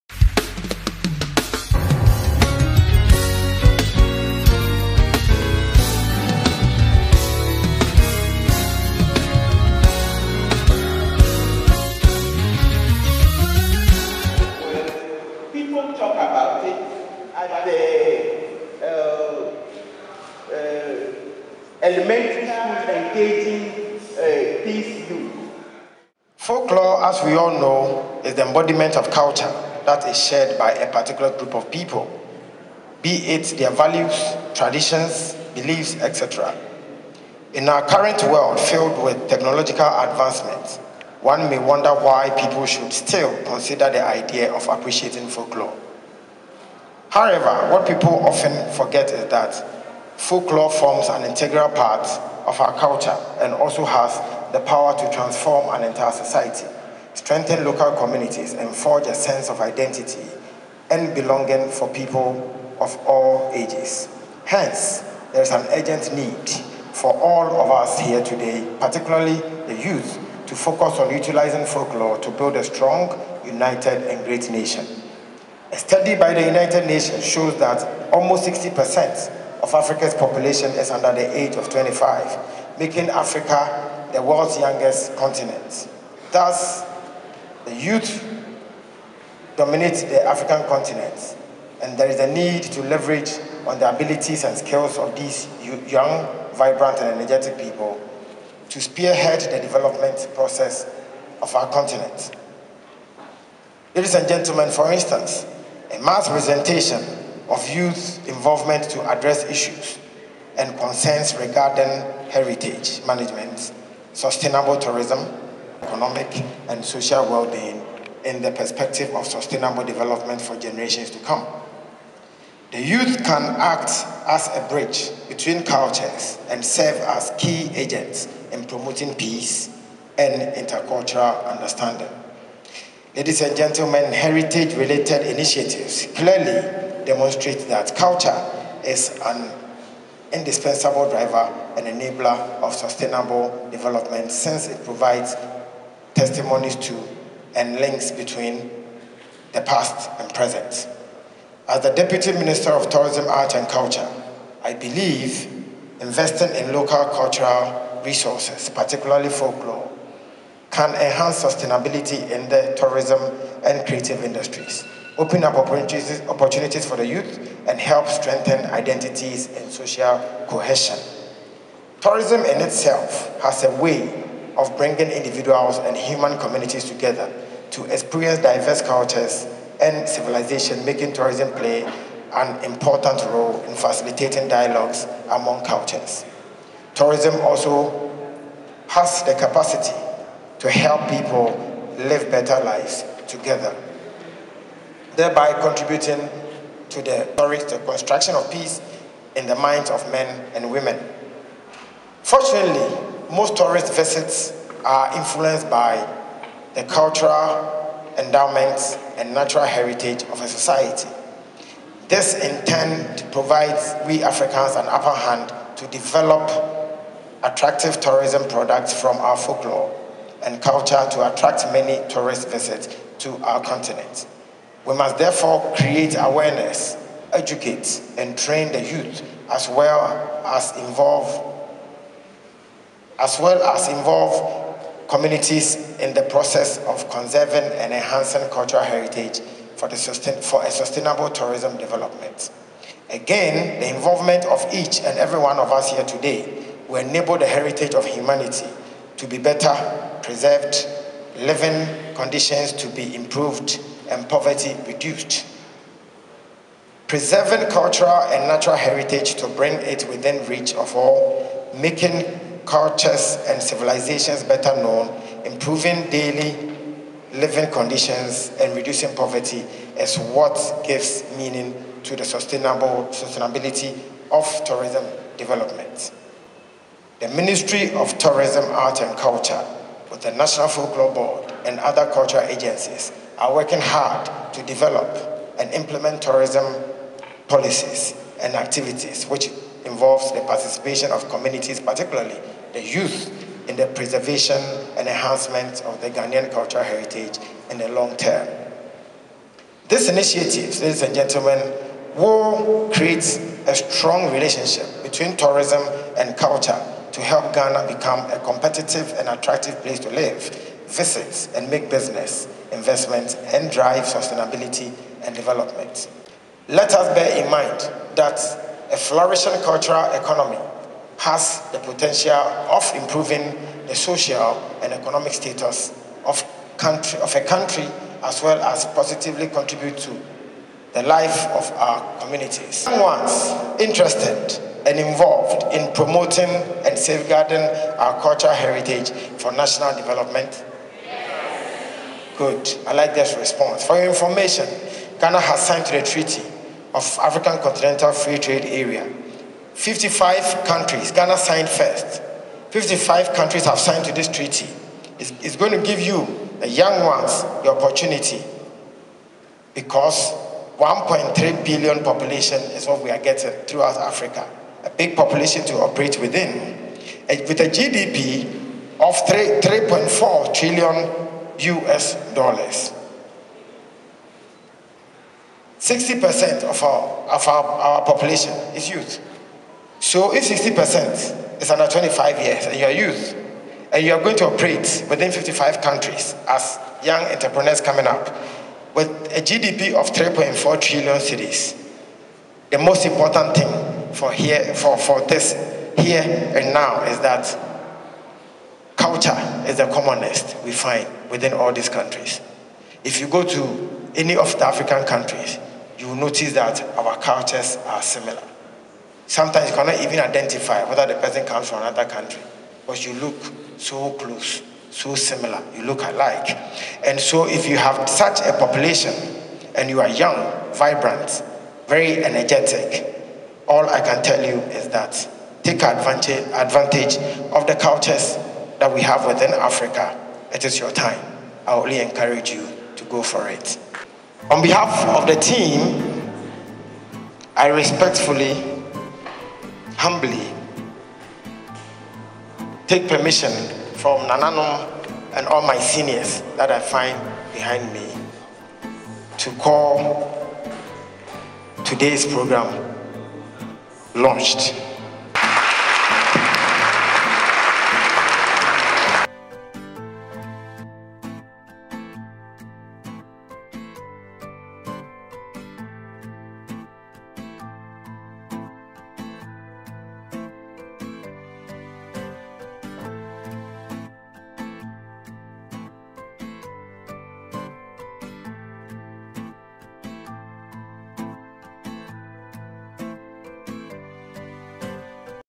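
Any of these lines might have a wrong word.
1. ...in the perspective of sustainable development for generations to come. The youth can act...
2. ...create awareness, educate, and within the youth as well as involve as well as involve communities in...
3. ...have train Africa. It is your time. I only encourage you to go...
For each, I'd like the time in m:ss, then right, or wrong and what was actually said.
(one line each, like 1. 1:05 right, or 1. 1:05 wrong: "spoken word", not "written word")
1. 1:58 right
2. 3:45 wrong: "train", not "within"
3. 7:09 wrong: "within", not "train".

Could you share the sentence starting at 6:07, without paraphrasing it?
Eh, with a GDP of 3.4 trillion US dollars.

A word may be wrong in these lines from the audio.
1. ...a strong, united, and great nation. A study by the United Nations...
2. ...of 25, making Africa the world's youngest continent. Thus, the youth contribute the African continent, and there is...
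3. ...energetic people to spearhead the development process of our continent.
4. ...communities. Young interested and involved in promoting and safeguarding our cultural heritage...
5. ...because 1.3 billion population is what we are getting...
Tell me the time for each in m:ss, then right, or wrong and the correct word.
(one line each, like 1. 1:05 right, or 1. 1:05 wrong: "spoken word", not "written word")
1. 1:12 right
2. 1:21 wrong: "dominate", not "contribute"
3. 1:37 right
4. 5:32 right
5. 5:59 right.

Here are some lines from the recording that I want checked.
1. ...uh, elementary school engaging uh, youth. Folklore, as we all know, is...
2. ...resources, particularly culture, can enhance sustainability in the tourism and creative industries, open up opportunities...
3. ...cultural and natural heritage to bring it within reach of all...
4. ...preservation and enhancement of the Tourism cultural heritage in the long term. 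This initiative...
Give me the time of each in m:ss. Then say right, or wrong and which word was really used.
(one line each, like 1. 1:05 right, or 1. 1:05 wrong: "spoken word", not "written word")
1. 0:20 right
2. 2:38 wrong: "folklore", not "culture"
3. 4:17 right
4. 4:53 wrong: "Ghanaian", not "Tourism".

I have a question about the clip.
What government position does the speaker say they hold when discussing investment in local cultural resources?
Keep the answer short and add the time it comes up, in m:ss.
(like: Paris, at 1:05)
Deputy Minister of Tourism, Art and Culture, at 2:31.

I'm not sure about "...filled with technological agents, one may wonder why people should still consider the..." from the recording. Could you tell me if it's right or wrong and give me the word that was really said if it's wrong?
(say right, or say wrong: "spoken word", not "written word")
wrong: "advancements", not "agents".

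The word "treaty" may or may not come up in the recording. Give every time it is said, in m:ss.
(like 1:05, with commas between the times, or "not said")
5:46, 5:54.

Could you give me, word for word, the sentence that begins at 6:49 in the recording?
Sometimes you cannot even identify whether the person comes from another country, because you look so close, so similar, you look alike.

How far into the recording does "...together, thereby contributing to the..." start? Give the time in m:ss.
3:13.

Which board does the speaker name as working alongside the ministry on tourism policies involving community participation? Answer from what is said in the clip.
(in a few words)
National Folklore Board.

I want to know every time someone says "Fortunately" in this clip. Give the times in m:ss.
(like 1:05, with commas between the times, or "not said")
3:22.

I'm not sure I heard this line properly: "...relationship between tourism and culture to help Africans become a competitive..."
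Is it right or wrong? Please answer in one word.
wrong.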